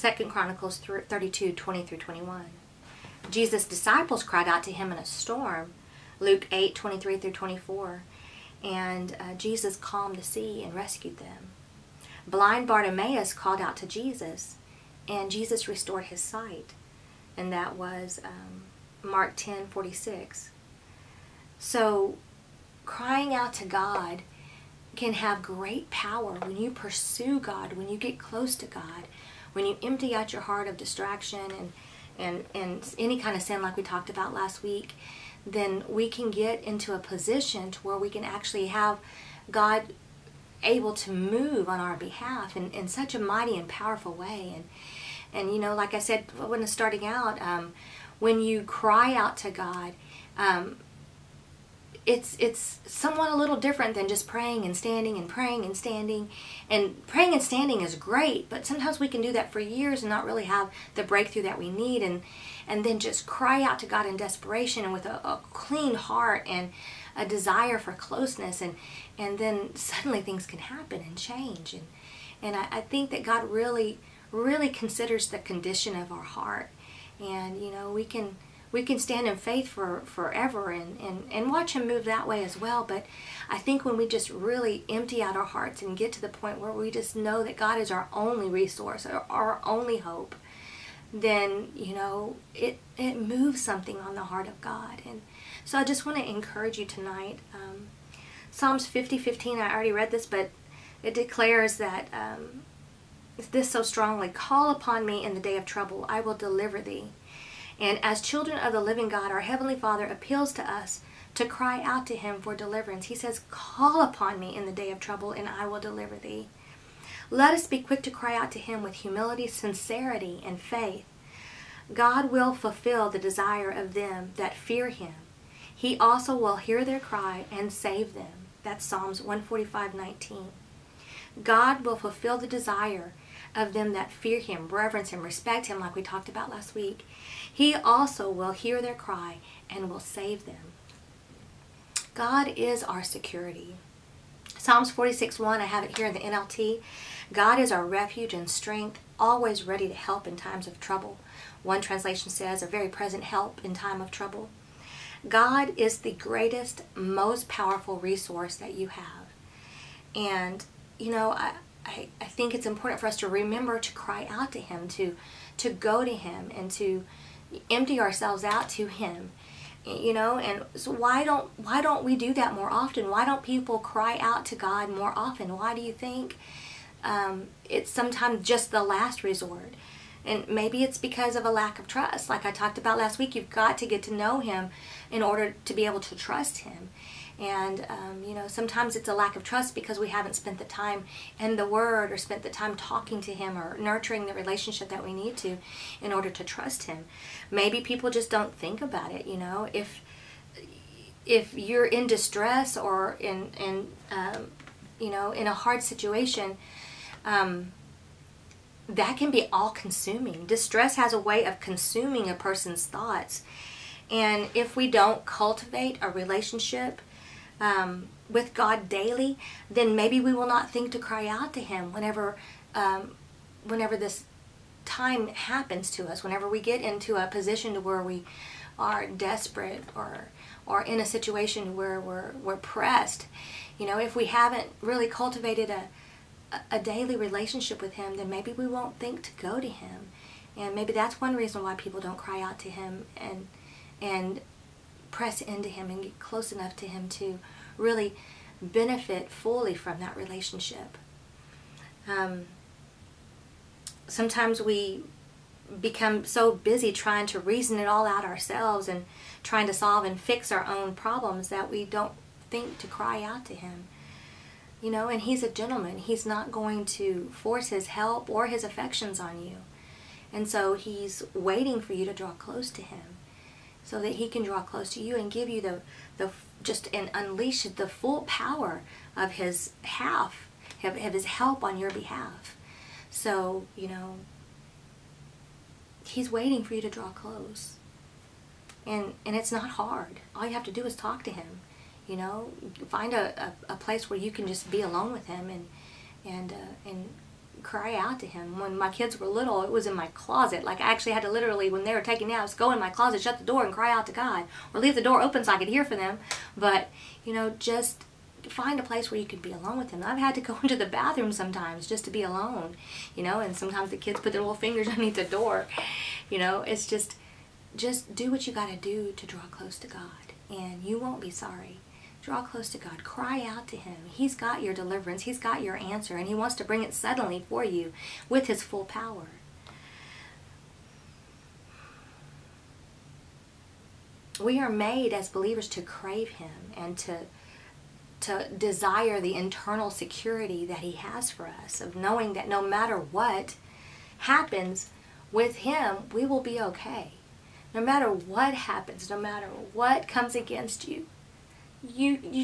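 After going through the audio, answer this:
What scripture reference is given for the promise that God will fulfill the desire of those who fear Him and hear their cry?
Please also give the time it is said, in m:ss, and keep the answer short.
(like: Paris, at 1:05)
Psalms 145:19, at 2:08.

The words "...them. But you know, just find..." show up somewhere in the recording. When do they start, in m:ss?
5:05.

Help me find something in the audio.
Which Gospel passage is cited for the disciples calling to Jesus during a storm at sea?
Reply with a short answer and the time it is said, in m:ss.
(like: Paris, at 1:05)
Luke 8:23-24, at 0:06.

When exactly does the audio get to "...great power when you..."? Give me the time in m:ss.
0:25.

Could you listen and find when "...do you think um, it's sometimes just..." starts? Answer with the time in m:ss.
2:55.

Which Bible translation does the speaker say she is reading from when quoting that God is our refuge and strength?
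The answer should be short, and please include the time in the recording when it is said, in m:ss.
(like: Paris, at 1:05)
NLT, at 2:26.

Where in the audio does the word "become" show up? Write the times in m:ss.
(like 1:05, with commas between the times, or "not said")
4:15.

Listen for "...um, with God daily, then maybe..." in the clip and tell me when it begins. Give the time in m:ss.
3:37.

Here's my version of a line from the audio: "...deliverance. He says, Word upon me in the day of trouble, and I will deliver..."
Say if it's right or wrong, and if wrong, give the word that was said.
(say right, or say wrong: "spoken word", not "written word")
wrong: "Call", not "Word".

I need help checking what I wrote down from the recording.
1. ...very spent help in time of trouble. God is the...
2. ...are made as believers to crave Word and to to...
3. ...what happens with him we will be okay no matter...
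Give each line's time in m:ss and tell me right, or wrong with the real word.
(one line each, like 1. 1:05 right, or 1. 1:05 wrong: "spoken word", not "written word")
1. 2:32 wrong: "present", not "spent"
2. 5:34 wrong: "Him", not "Word"
3. 5:42 right.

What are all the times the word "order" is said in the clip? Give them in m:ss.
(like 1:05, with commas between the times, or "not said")
3:05, 3:16.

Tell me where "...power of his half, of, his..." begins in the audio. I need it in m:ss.
4:38.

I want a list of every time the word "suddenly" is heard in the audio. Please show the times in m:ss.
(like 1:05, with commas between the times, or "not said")
1:09, 5:26.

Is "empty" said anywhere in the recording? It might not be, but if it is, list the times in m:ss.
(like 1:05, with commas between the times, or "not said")
0:29, 1:24, 2:47.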